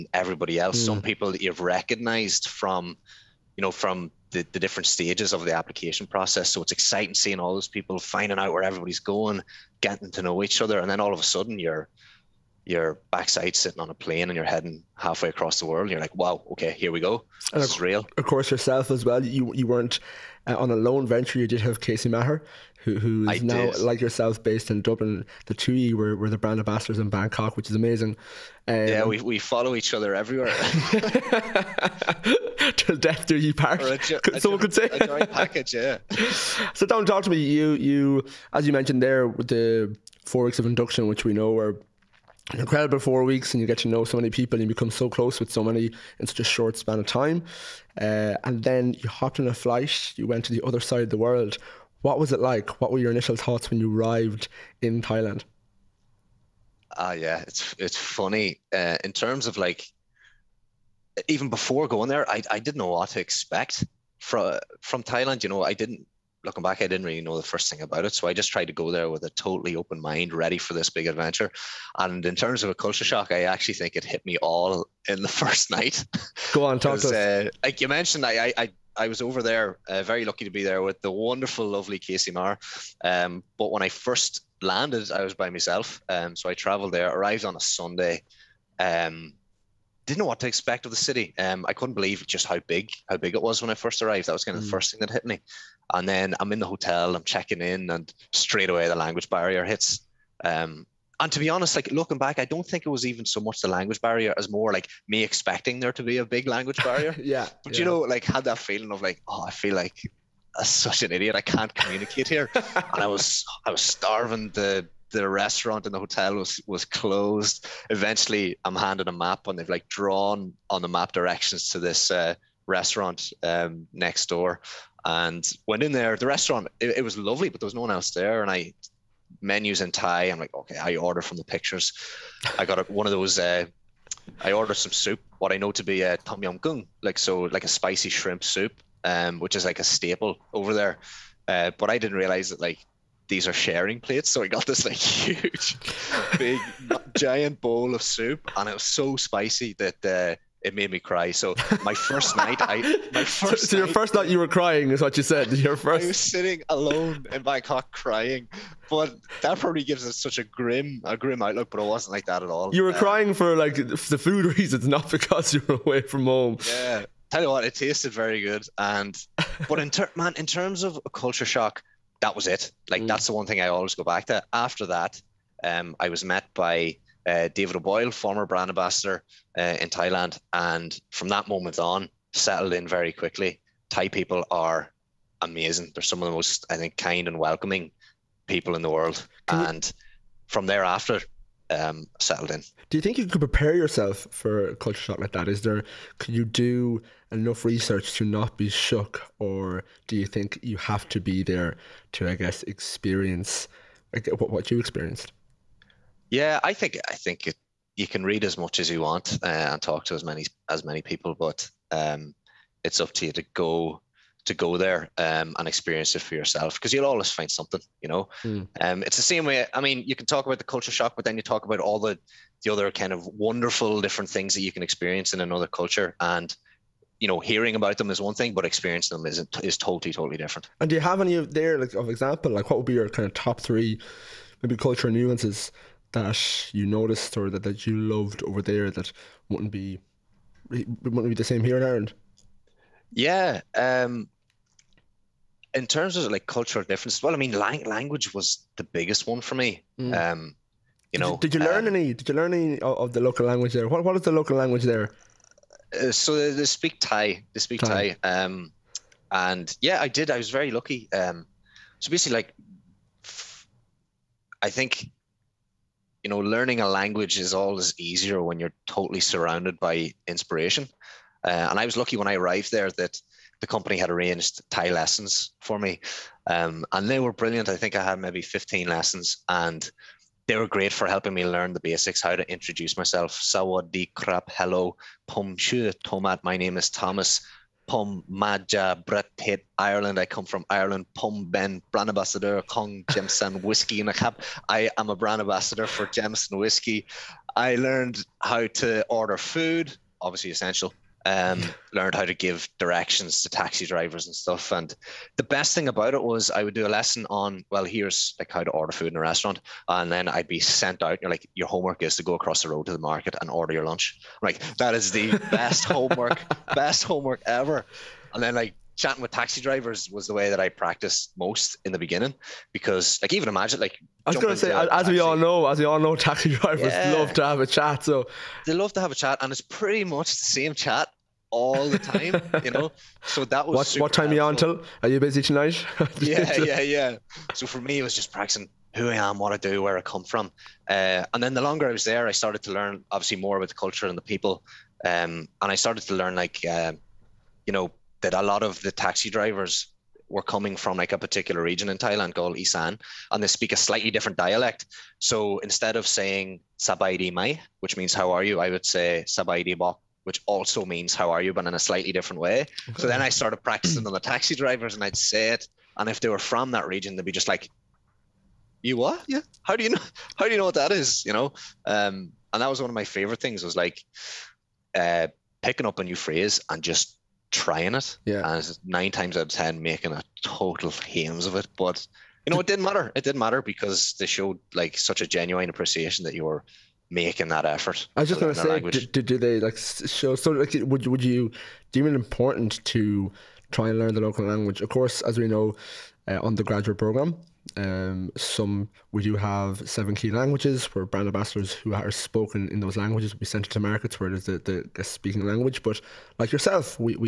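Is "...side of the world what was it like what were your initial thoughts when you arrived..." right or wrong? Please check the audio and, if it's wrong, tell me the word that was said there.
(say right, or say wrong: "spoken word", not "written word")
right.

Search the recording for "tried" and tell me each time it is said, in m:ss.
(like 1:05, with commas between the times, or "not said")
1:08.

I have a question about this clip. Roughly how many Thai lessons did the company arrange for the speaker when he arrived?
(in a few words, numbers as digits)
15.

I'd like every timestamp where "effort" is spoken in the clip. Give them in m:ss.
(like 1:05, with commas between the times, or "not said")
6:27.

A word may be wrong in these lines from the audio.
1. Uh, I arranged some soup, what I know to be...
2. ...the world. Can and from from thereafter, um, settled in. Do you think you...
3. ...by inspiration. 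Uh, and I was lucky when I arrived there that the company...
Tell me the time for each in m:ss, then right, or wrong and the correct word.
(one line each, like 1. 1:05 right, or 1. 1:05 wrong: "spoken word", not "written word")
1. 2:13 wrong: "ordered", not "arranged"
2. 3:08 right
3. 4:29 right.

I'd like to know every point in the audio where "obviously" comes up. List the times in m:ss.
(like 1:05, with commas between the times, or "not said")
5:00, 5:43.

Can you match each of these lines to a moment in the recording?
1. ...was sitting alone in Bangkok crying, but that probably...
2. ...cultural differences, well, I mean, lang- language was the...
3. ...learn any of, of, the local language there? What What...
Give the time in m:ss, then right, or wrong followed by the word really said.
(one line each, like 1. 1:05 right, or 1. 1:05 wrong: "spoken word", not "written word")
1. 2:36 right
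2. 4:06 right
3. 4:12 right.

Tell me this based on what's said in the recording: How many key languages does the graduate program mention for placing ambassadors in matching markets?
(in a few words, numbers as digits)
7.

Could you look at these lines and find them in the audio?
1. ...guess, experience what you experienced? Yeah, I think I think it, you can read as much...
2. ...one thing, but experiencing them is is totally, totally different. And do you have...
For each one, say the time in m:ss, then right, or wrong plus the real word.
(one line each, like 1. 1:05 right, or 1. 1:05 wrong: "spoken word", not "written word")
1. 3:22 right
2. 3:48 right.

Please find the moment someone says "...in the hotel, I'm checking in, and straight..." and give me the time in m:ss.
1:36.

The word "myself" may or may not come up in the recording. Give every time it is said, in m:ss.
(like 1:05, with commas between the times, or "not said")
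1:25, 4:42.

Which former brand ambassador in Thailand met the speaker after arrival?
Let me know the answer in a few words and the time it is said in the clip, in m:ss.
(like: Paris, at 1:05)
David O'Boyle, at 2:57.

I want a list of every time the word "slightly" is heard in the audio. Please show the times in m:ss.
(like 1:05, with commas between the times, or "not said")
5:53, 6:01.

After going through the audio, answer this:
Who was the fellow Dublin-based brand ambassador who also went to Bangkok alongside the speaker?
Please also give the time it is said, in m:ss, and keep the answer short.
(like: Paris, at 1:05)
Casey Maher, at 0:21.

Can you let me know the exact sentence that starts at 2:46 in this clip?
Yeah, tell you what, it tasted very good.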